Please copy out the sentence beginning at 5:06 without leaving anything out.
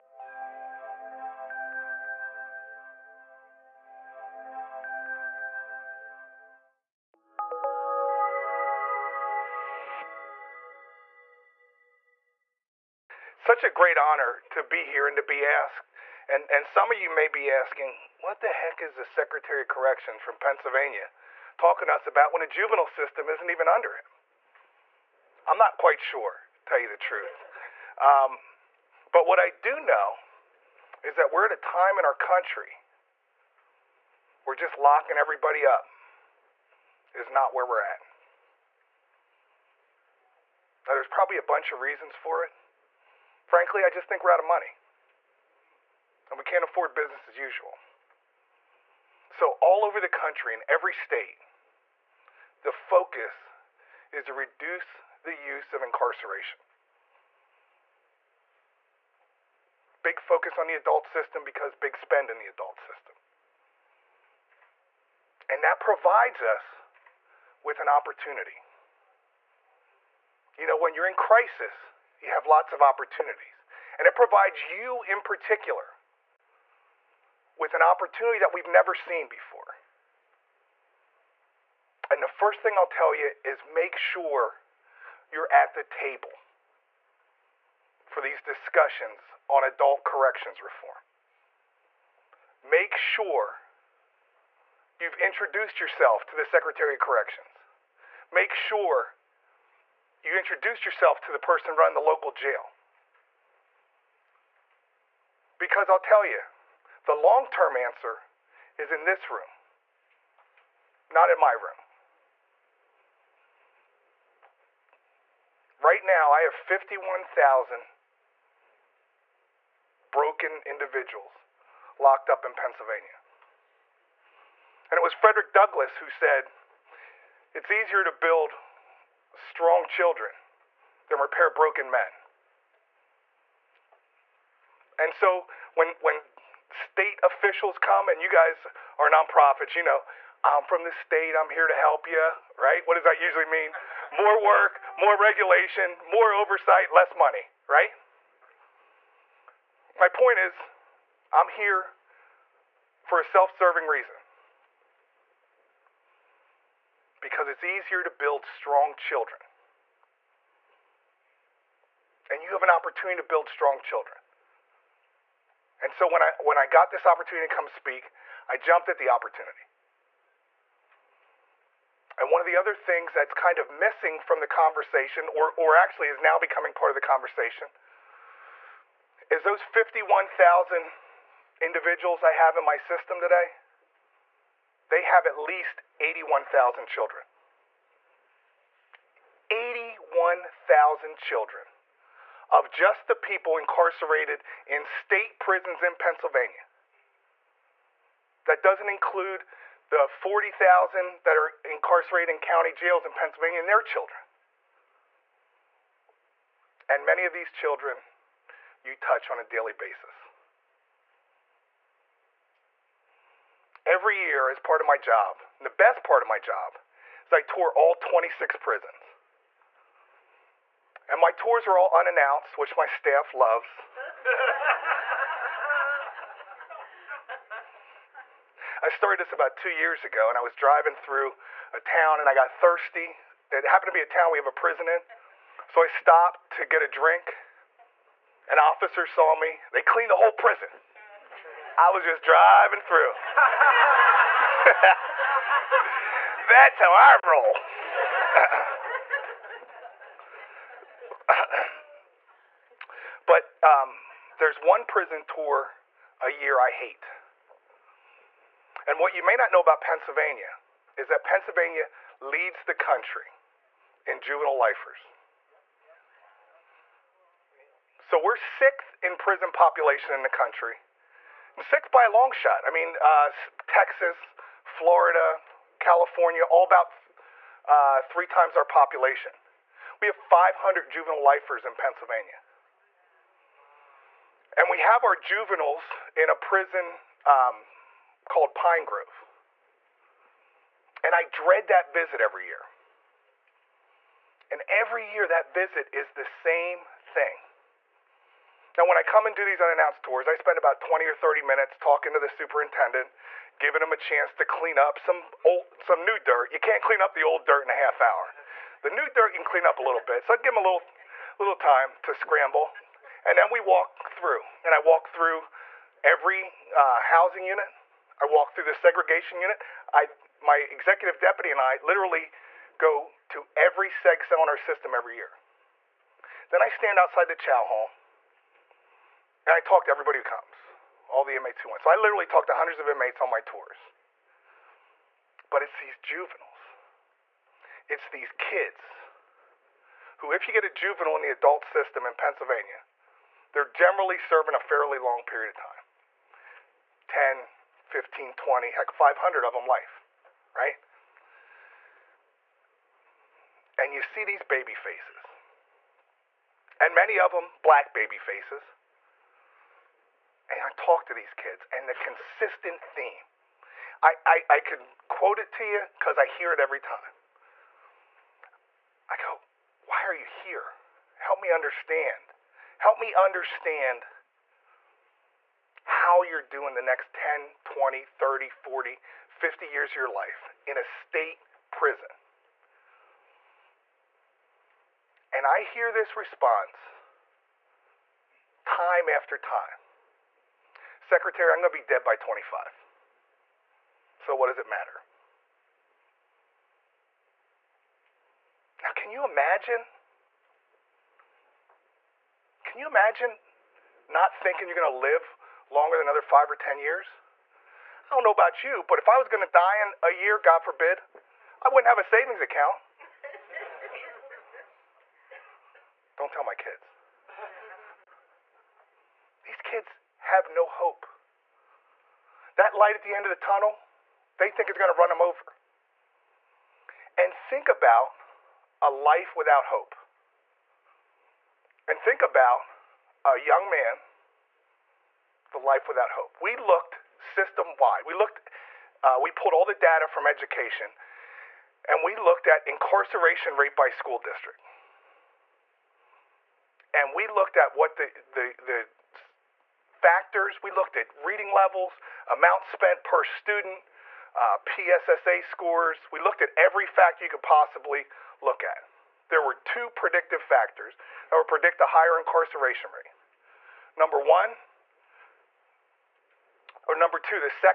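You can't clean up the old dirt in a half hour.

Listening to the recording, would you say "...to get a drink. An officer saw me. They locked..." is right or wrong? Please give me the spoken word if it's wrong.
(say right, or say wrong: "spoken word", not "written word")
wrong: "cleaned", not "locked".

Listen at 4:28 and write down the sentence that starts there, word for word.
So we're sixth in prison population in the country.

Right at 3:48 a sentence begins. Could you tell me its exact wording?
I started this about two years ago, and I was driving through a town and I got thirsty.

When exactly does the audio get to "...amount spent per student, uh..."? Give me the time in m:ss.
7:32.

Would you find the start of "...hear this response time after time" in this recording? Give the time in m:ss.
6:25.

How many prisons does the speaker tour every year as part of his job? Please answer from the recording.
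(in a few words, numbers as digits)
26.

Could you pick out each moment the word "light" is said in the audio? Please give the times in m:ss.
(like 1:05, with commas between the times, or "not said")
7:02.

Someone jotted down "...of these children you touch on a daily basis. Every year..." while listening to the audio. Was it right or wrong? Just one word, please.
right.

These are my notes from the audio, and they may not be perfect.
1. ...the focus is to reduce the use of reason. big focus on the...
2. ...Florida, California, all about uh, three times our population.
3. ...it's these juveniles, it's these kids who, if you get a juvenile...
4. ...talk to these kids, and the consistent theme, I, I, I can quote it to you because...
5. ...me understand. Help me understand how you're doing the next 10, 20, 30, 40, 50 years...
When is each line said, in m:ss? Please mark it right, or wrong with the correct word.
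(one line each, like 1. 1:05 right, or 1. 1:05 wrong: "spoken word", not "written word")
1. 0:52 wrong: "incarceration", not "reason"
2. 4:34 right
3. 5:35 right
4. 6:00 right
5. 6:11 right.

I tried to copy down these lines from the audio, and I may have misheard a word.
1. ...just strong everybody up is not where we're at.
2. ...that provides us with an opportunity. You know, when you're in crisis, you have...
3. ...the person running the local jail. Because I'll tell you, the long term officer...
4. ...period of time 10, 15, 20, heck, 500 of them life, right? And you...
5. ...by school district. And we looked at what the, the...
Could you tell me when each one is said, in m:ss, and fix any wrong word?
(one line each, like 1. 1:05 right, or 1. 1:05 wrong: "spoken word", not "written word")
1. 0:34 wrong: "locking", not "strong"
2. 1:05 right
3. 1:41 wrong: "answer", not "officer"
4. 5:45 right
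5. 7:23 right.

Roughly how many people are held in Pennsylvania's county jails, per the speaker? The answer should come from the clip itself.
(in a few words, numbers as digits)
40,000.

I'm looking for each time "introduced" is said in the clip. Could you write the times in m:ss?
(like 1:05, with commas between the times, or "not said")
1:35, 1:40.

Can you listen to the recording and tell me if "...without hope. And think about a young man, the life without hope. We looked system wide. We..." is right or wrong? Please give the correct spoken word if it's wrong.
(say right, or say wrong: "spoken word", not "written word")
right.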